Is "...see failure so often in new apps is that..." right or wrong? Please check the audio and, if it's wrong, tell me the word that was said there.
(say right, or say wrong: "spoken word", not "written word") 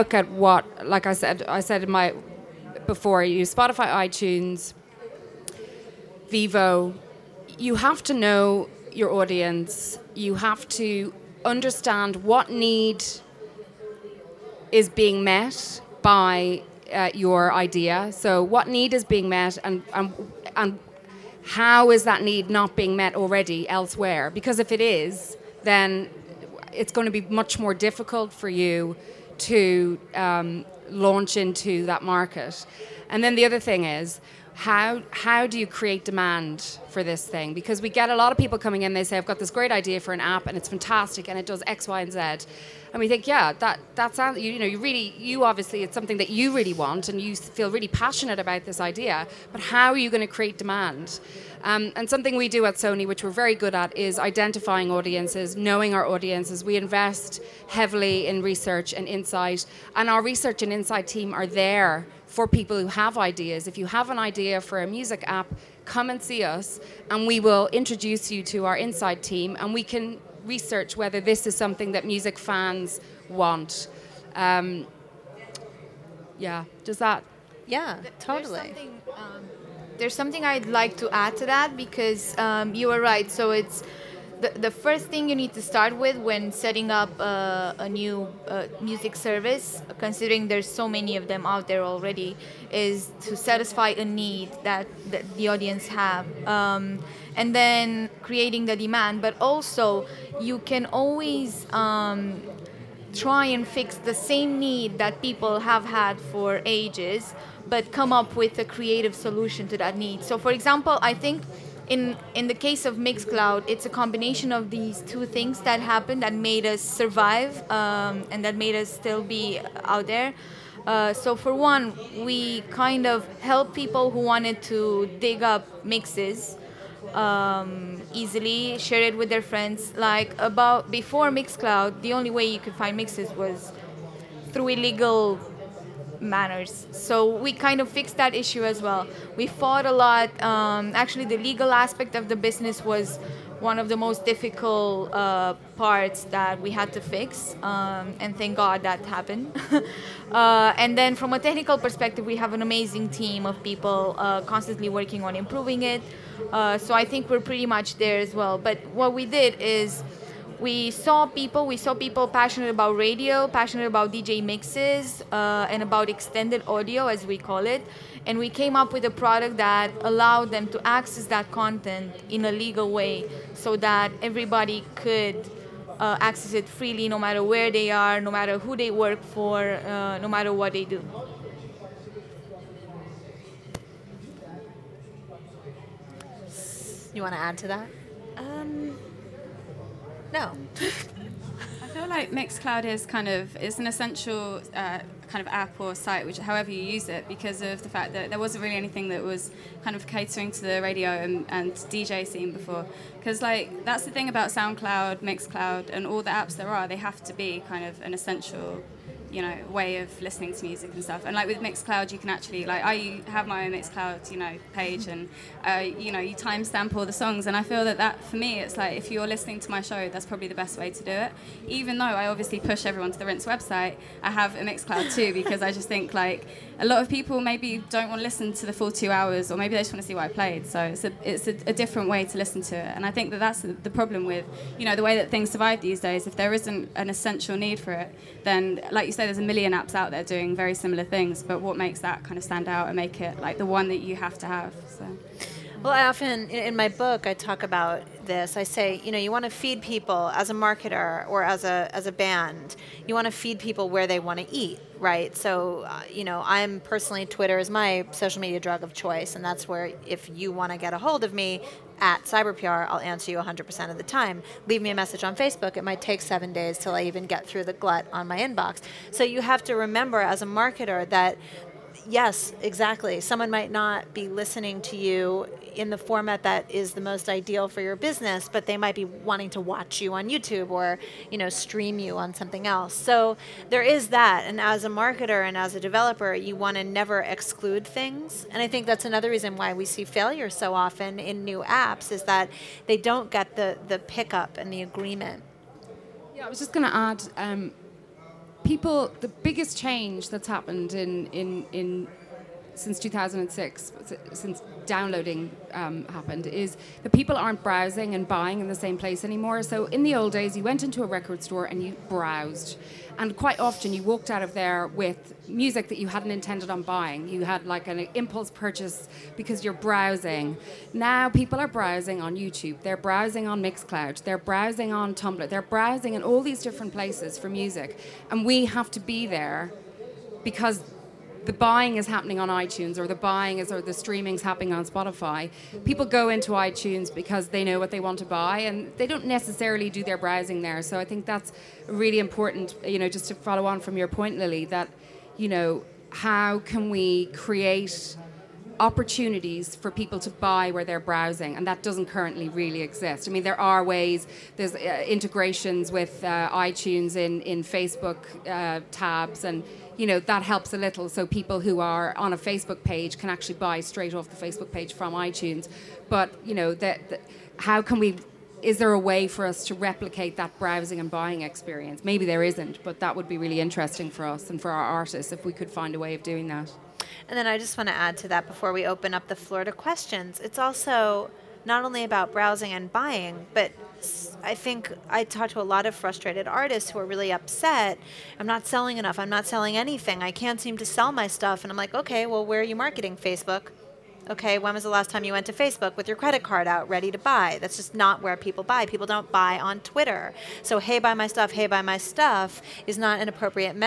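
right.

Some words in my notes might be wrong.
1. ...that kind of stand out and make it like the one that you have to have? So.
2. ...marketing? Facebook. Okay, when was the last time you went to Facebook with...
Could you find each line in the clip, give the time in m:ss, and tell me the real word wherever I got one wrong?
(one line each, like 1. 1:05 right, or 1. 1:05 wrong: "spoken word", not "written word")
1. 4:01 right
2. 6:32 right.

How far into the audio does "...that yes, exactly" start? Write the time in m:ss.
4:31.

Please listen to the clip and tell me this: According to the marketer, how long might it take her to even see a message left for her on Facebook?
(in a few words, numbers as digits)
7 days.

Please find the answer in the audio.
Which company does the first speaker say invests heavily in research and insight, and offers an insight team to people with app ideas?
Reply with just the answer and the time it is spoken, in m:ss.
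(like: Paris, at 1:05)
Sony, at 0:52.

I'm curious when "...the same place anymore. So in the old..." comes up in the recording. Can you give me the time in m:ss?
5:08.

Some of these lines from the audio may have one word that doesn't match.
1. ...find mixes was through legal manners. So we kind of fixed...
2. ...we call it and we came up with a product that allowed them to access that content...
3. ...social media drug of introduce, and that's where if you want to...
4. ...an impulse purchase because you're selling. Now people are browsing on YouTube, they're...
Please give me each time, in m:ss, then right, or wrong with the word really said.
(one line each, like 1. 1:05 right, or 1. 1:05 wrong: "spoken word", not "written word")
1. 2:12 wrong: "illegal", not "legal"
2. 2:47 right
3. 4:18 wrong: "choice", not "introduce"
4. 5:17 wrong: "browsing", not "selling".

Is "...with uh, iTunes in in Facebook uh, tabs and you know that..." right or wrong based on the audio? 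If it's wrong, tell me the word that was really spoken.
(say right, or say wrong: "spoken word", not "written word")
right.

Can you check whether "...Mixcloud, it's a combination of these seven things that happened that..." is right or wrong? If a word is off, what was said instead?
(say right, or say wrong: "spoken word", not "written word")
wrong: "two", not "seven".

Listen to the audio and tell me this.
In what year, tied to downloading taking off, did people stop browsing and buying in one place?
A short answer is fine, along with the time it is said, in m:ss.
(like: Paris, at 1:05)
2006, at 5:02.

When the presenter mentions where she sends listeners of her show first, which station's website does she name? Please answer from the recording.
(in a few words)
Rinse.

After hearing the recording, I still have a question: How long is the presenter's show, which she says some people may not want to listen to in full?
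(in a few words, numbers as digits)
2 hours.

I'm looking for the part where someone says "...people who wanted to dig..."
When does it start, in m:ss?
2:03.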